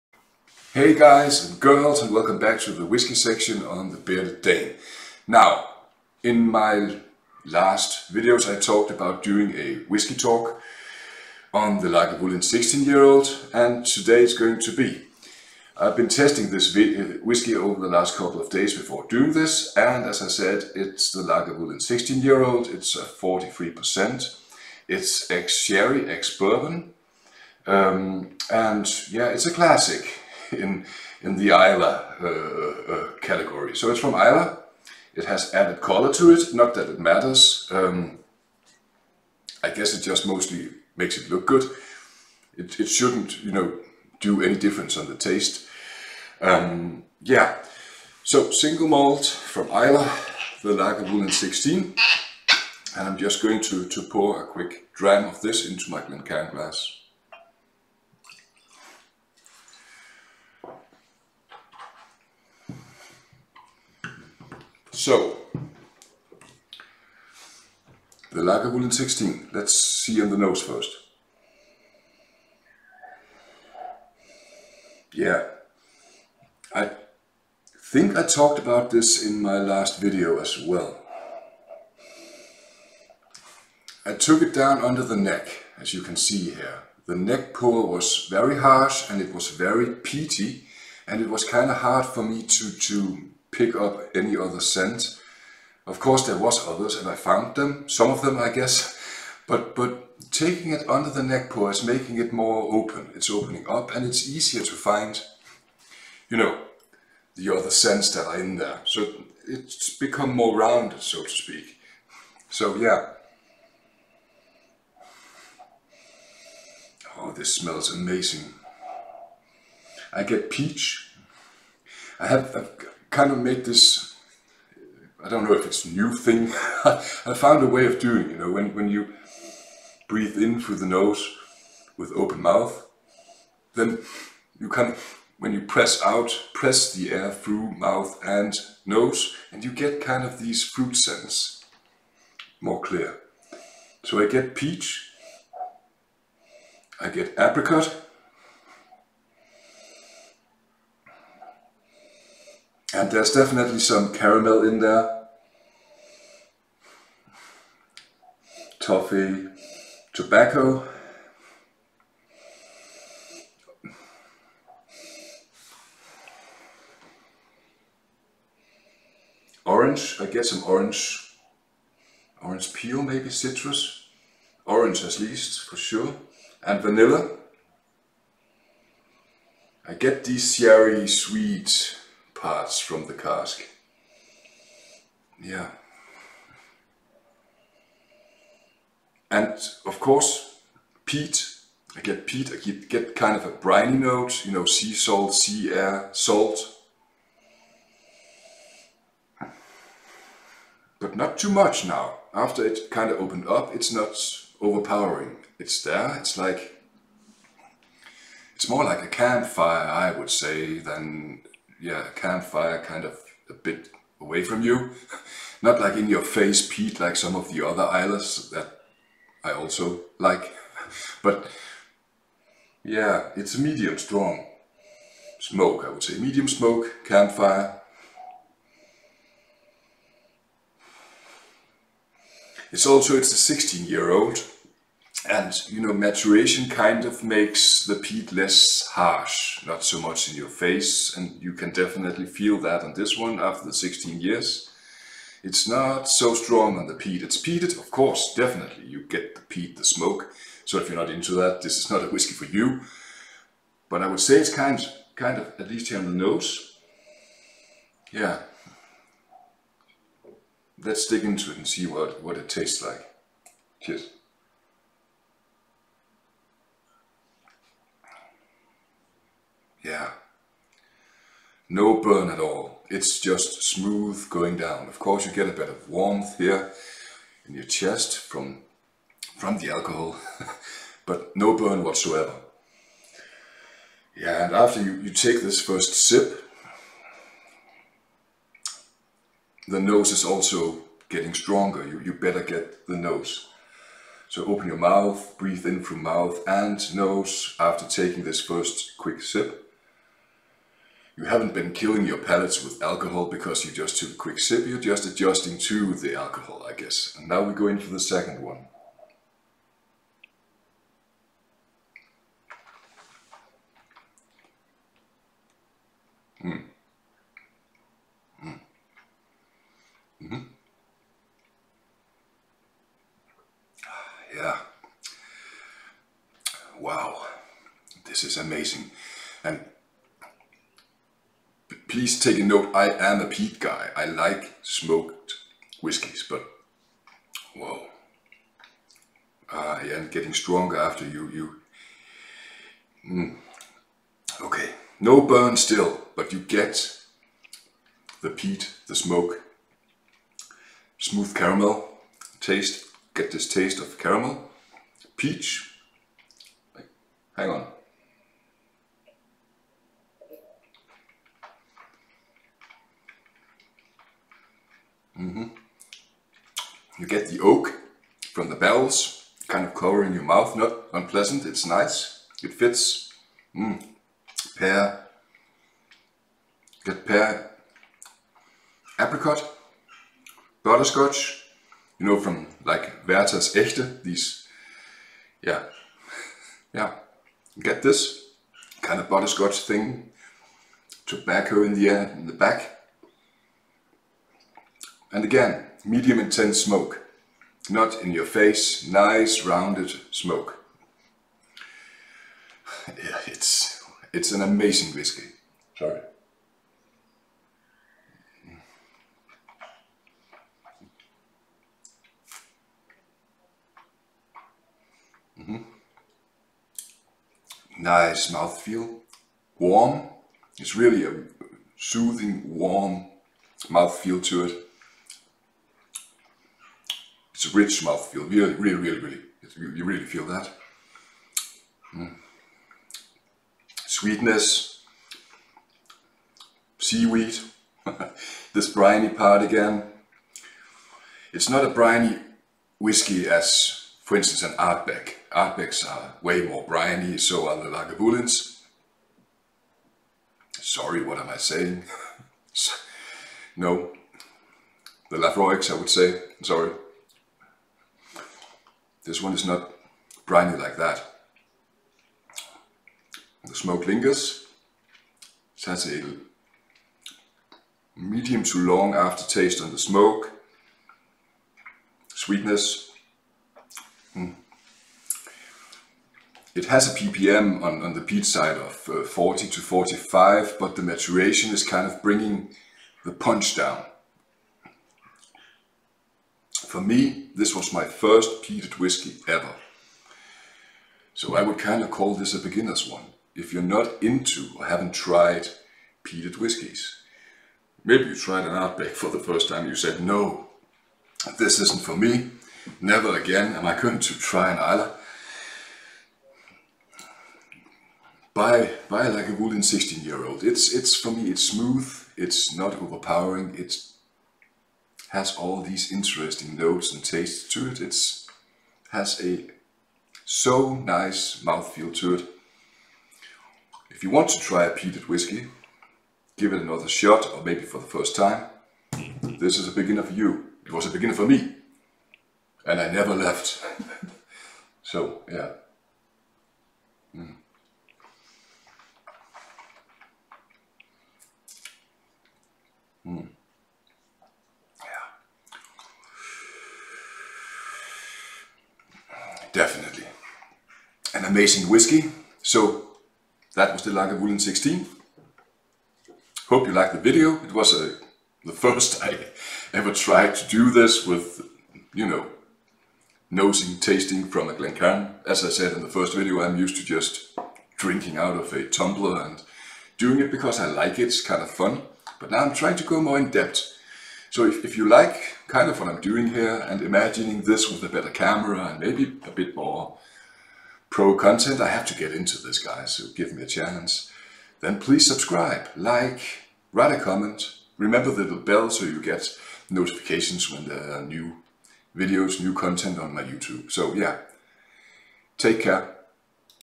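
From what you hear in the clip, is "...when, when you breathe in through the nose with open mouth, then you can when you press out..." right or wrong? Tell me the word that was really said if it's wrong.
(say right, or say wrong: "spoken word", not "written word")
right.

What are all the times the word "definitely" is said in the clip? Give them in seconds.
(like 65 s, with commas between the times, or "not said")
153 s, 241 s, 248 s.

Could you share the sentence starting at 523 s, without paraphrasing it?
If you want to try a peated whiskey, give it another shot or maybe for the first time.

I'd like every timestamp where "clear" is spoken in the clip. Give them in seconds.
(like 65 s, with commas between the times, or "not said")
142 s.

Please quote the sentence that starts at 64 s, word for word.
So, the Lagavulin 16, let's see on the nose first.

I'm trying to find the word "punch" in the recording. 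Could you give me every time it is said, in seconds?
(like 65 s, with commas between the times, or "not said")
483 s.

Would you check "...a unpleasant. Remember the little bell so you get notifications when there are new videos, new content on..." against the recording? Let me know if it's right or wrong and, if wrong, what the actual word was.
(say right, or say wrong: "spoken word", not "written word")
wrong: "comment", not "unpleasant".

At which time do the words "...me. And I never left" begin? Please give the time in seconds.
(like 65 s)
531 s.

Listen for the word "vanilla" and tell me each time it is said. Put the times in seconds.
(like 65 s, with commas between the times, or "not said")
176 s.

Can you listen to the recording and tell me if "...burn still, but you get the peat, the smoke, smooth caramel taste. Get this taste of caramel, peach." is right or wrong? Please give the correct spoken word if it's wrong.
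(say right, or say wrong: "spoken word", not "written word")
right.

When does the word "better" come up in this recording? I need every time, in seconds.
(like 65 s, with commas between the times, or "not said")
292 s, 577 s.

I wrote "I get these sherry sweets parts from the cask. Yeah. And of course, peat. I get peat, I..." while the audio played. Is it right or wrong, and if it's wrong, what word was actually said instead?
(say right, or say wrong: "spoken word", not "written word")
right.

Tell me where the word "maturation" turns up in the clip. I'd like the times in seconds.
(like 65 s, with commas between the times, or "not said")
235 s, 480 s.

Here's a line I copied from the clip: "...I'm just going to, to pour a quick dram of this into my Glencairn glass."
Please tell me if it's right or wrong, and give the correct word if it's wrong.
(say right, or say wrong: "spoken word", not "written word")
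right.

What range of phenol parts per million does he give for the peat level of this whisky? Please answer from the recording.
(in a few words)
40 to 45.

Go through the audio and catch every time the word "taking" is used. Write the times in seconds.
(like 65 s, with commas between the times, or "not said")
100 s, 297 s.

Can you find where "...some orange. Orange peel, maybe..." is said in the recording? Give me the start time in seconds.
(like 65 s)
170 s.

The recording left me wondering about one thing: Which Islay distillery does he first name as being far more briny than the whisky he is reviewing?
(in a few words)
Ardbeg.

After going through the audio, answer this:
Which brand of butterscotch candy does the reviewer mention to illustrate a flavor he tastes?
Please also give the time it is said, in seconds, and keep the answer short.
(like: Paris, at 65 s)
Werther's Echte, at 383 s.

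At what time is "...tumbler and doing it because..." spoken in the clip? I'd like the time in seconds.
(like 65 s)
568 s.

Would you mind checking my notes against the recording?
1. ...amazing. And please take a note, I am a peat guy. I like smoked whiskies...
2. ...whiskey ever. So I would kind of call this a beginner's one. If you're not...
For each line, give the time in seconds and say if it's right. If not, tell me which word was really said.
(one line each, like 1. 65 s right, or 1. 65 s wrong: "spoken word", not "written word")
1. 328 s right
2. 488 s right.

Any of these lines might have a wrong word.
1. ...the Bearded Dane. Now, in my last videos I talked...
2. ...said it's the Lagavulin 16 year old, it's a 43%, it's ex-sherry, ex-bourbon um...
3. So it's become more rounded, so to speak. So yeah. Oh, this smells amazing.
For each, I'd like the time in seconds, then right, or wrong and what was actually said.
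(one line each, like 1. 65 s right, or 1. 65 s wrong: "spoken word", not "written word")
1. 3 s right
2. 20 s right
3. 108 s right.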